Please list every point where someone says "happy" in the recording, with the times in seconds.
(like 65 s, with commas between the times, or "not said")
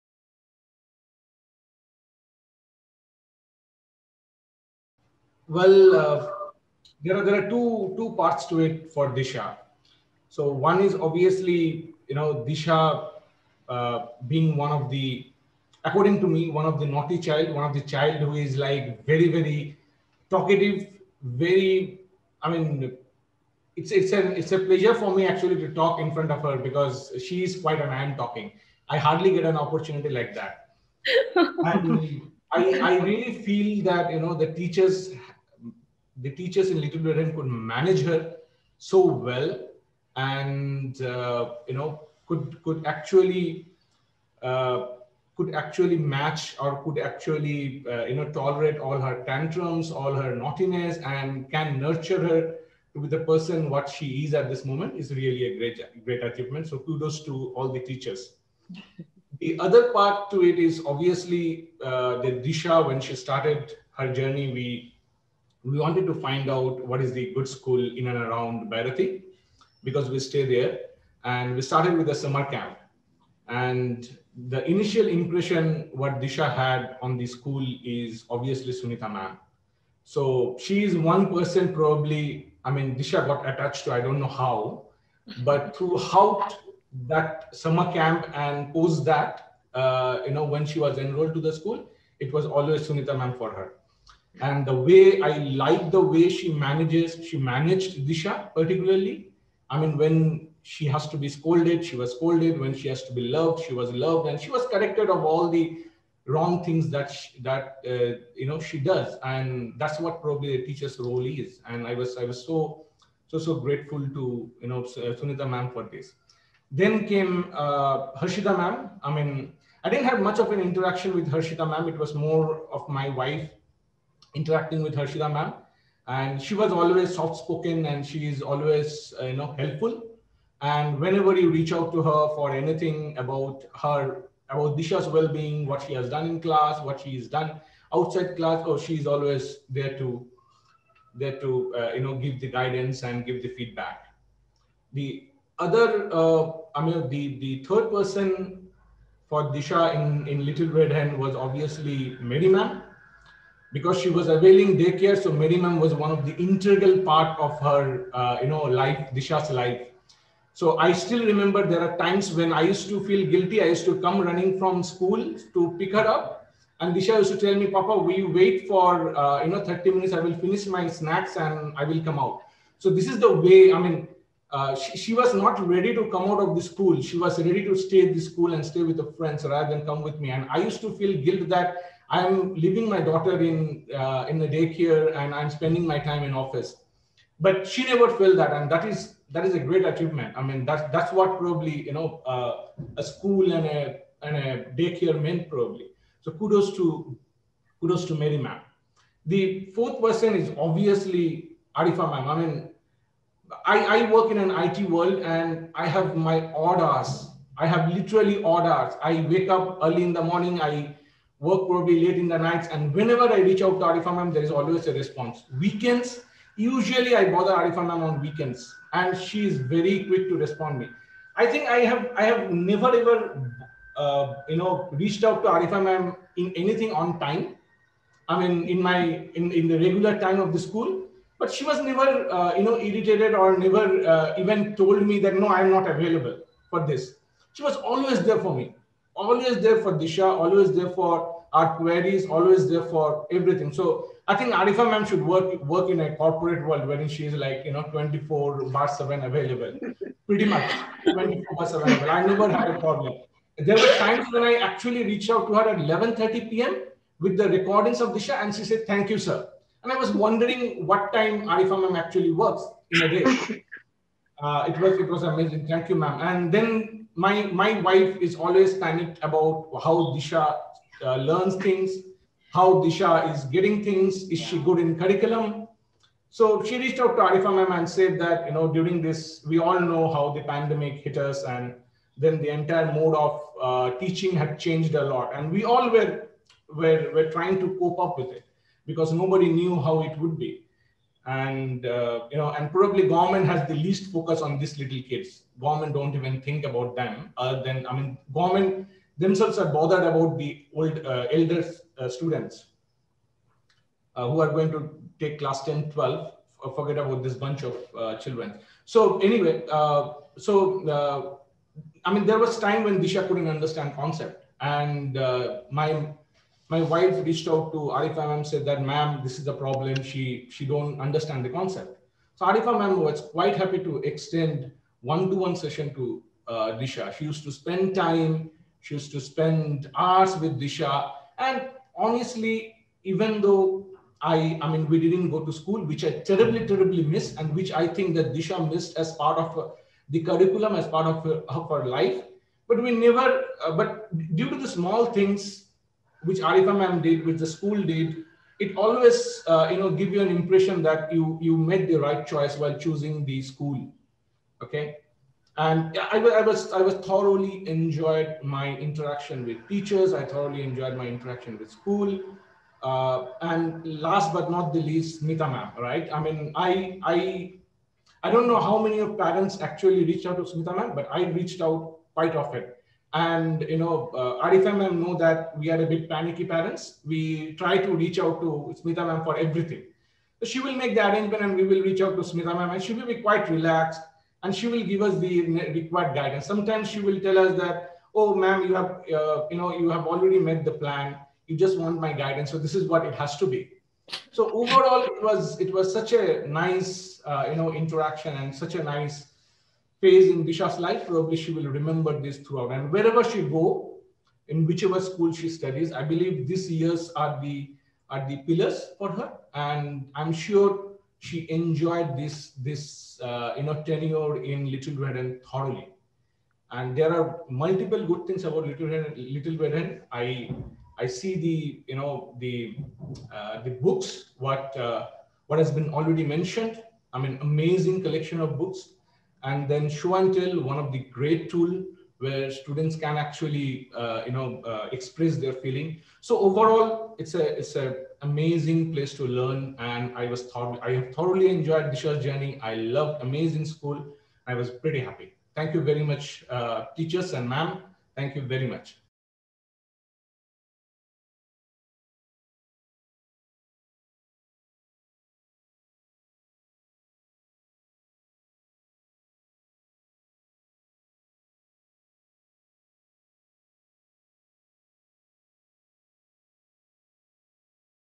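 323 s, 444 s.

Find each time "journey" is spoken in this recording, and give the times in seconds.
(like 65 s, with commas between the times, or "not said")
64 s, 442 s.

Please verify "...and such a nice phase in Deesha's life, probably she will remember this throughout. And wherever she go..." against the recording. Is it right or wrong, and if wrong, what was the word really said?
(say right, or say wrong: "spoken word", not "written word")
right.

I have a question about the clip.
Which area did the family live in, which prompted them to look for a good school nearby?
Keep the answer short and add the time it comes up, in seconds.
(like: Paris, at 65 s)
Bharati, at 68 s.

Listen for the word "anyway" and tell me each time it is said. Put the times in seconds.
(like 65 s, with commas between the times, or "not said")
309 s.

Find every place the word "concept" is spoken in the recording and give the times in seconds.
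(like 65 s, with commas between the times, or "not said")
313 s, 321 s.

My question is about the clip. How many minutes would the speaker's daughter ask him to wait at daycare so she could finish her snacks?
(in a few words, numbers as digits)
30 minutes.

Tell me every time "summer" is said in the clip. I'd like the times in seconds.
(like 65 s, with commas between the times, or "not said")
72 s, 87 s.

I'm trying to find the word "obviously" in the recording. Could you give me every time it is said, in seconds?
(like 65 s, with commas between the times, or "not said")
10 s, 60 s, 78 s, 151 s, 200 s.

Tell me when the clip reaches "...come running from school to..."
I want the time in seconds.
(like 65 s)
164 s.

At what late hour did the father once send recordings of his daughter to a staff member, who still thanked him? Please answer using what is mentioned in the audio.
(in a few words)
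11:30 p.m.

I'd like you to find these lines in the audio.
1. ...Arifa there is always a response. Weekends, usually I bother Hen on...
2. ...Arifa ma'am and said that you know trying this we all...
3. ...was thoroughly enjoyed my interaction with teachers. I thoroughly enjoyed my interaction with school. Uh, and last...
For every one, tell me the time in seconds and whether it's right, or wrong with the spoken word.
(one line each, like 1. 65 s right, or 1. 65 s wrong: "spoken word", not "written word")
1. 213 s wrong: "Arifa", not "Hen"
2. 277 s wrong: "during", not "trying"
3. 356 s right.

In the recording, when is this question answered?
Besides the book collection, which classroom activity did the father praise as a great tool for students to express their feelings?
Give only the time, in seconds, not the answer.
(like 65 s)
429 s.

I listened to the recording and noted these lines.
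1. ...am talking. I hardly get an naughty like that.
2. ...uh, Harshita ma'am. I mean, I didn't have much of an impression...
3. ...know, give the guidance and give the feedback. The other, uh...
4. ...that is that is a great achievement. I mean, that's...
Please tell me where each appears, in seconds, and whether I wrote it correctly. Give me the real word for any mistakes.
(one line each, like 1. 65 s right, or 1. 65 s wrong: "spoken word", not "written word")
1. 28 s wrong: "opportunity", not "naughty"
2. 117 s wrong: "interaction", not "impression"
3. 142 s right
4. 188 s right.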